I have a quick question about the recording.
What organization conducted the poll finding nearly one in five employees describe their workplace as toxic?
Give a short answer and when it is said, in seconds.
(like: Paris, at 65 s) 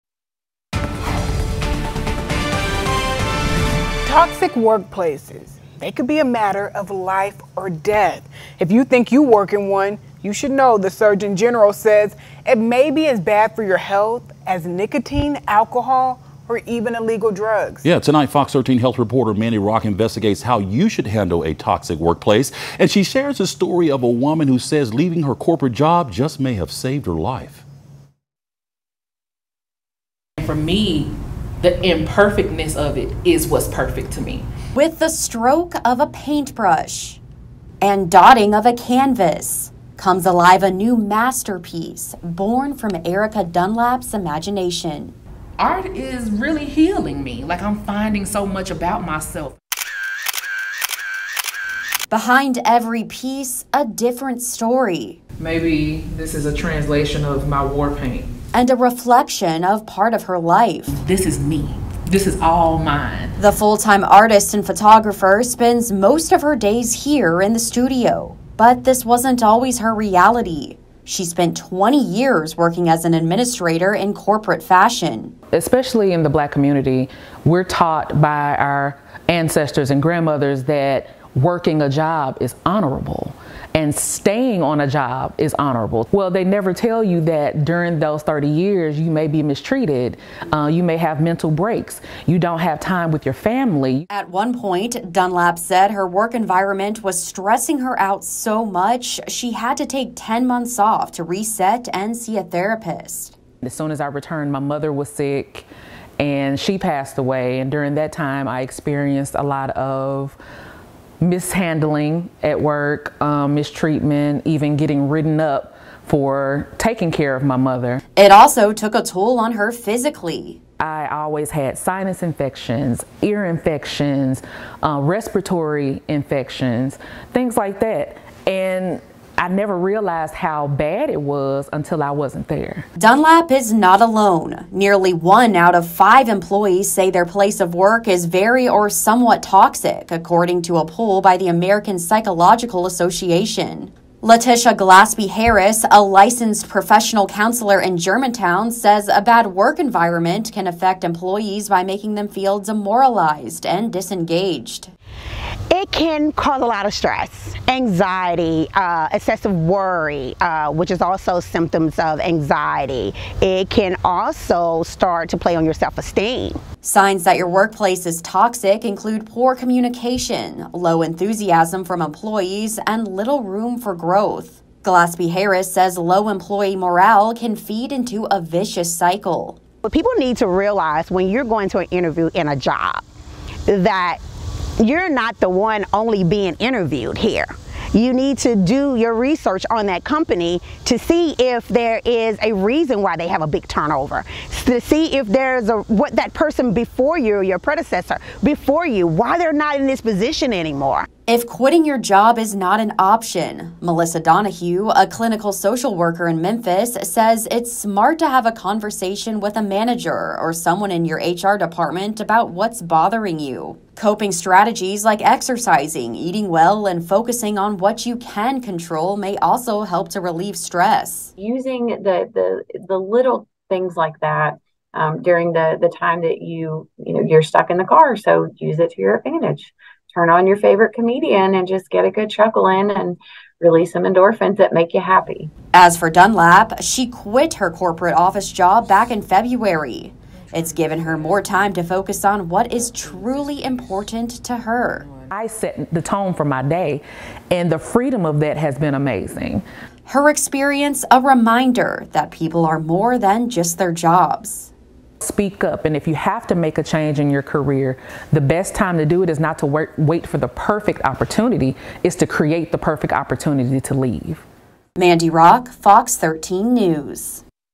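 American Psychological Association, at 141 s.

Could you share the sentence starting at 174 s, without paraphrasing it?
Gillespie Harris says low employee morale can feed into a vicious cycle.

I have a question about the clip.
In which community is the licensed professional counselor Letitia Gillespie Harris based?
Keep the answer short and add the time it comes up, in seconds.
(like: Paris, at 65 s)
Germantown, at 147 s.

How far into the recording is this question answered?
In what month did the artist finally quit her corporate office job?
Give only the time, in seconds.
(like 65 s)
239 s.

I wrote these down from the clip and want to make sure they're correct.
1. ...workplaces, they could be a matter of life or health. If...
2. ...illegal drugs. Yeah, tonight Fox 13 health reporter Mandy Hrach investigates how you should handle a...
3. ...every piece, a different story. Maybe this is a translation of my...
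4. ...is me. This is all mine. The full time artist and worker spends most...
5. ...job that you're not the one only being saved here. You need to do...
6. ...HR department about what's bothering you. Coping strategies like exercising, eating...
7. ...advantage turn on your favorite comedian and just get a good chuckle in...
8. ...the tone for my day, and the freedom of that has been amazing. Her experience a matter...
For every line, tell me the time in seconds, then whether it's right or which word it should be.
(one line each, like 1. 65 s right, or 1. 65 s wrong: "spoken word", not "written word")
1. 4 s wrong: "death", not "health"
2. 16 s right
3. 52 s right
4. 61 s wrong: "photographer", not "worker"
5. 182 s wrong: "interviewed", not "saved"
6. 211 s right
7. 229 s right
8. 245 s wrong: "reminder", not "matter".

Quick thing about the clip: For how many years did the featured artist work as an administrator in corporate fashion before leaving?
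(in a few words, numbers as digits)
20.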